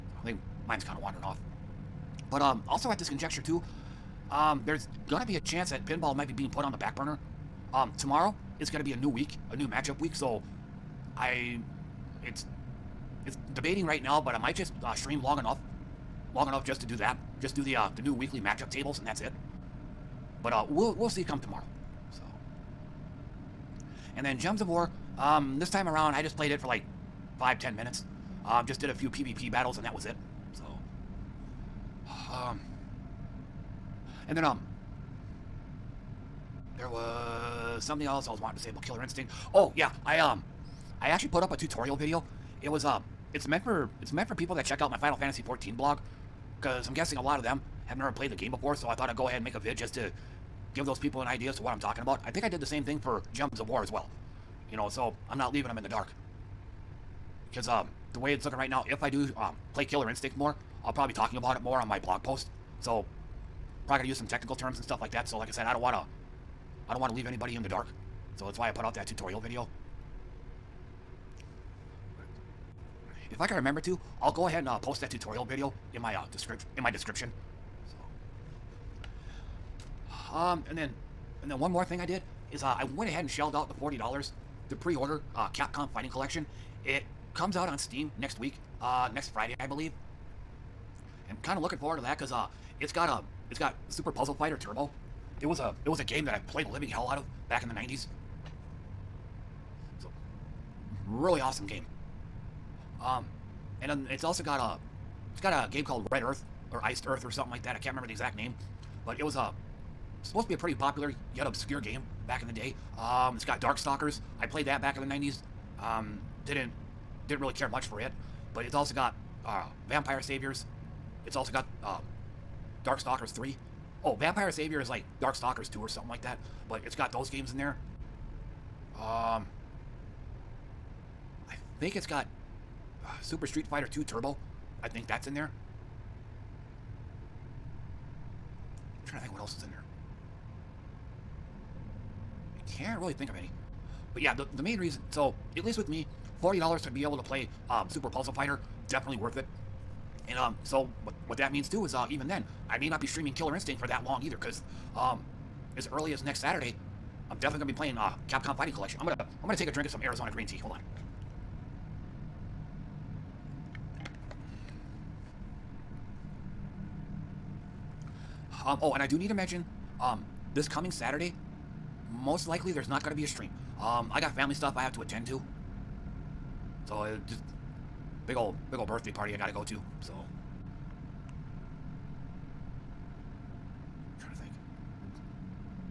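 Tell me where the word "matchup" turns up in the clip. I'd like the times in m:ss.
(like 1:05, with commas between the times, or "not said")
0:09, 0:18.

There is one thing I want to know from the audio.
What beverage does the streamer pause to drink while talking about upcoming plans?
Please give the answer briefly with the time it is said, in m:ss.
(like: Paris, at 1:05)
Arizona green tea, at 2:40.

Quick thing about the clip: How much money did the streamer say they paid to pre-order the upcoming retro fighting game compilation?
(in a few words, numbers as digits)
$40.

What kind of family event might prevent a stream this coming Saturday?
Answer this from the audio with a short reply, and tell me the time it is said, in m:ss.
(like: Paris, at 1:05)
birthday party, at 2:58.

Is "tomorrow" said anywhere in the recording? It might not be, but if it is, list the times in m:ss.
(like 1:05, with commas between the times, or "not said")
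0:07, 0:21.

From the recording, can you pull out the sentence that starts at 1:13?
If I can remember to, I'll go ahead and uh, post that tutorial video in my uh, description in my description.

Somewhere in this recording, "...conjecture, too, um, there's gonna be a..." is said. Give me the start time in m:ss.
0:03.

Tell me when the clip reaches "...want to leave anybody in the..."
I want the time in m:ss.
1:07.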